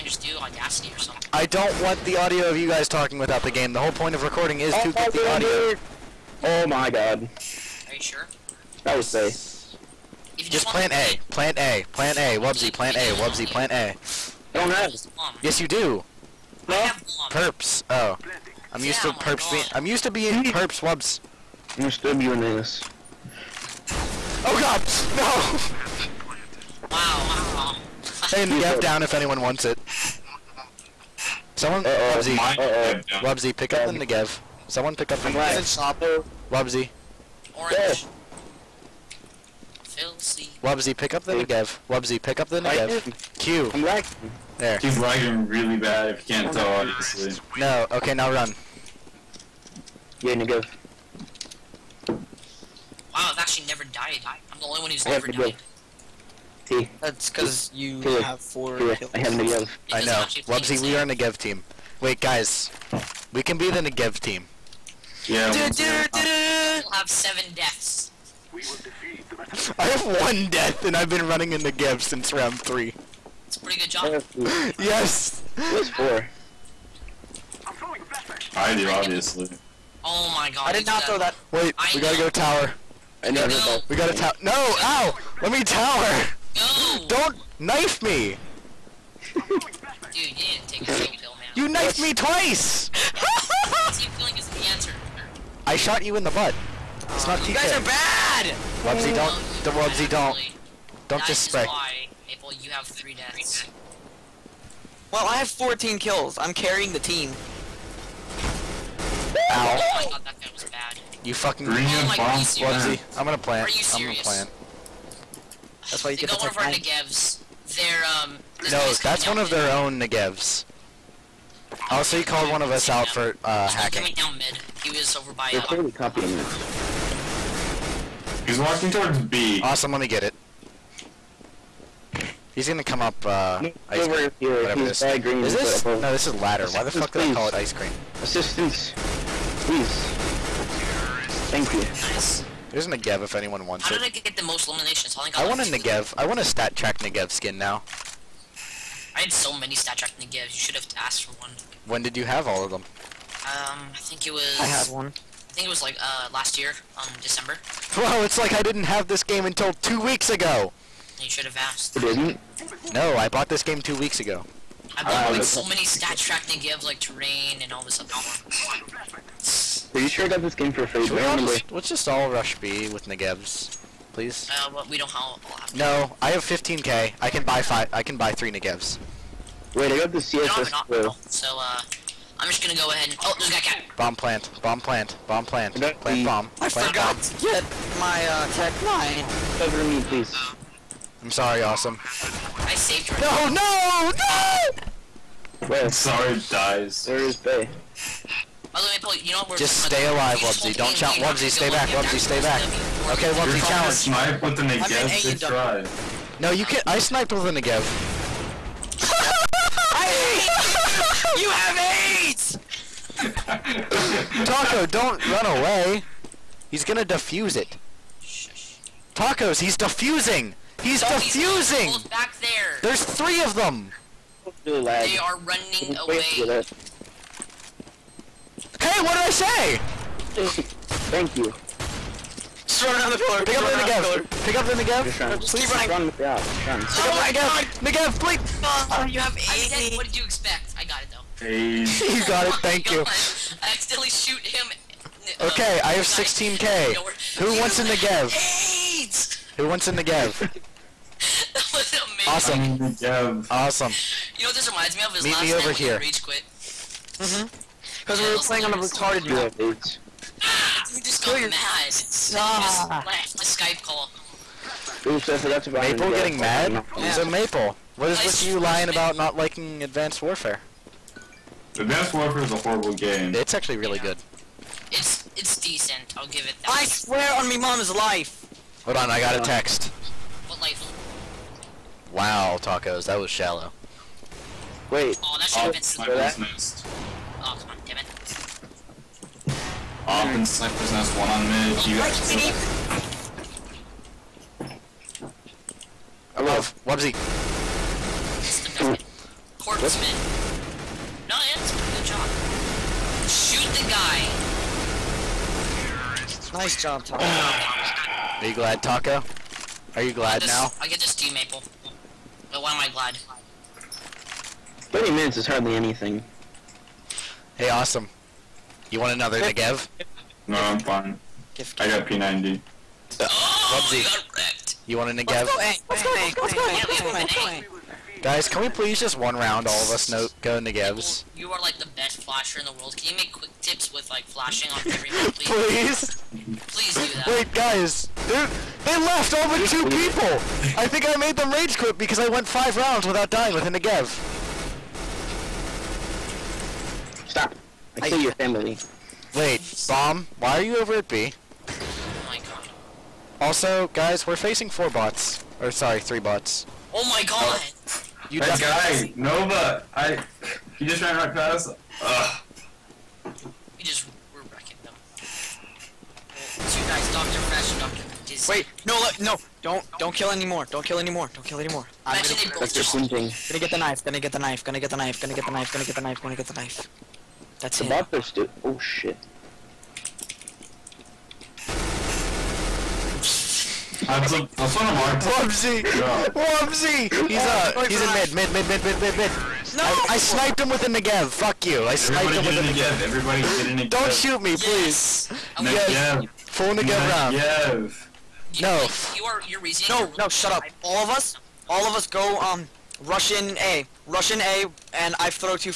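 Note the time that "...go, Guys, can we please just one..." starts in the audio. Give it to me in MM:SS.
05:27.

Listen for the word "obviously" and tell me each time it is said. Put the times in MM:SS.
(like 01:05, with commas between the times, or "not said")
00:46, 01:18.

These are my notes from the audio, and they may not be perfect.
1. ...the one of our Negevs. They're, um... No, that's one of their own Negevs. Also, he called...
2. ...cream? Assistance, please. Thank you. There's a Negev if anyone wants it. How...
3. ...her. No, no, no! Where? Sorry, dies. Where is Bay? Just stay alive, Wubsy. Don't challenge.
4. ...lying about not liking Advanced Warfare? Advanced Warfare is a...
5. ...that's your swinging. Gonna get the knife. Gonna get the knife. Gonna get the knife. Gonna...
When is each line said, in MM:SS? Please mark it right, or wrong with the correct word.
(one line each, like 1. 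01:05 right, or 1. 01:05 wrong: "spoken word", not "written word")
1. 01:56 right
2. 02:17 right
3. 03:13 right
4. 04:28 right
5. 06:12 right.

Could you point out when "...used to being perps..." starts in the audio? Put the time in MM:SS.
00:19.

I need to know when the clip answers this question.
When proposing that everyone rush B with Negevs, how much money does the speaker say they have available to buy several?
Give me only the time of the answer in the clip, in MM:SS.
02:56.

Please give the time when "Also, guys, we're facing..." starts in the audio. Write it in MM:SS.
05:53.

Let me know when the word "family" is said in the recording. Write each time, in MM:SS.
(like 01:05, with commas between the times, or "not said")
05:48.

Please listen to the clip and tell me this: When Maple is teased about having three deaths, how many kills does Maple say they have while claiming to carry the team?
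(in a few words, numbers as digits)
14.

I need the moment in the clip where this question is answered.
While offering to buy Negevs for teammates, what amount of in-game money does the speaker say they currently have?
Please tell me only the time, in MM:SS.
04:06.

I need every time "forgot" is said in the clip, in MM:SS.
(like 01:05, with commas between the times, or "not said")
03:06, 04:25.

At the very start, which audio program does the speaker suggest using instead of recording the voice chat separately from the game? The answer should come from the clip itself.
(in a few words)
Audacity.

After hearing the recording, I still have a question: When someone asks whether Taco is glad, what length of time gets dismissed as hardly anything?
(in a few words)
30 minutes.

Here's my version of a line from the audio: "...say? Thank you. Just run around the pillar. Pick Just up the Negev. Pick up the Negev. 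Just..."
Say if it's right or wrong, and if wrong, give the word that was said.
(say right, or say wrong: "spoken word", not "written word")
right.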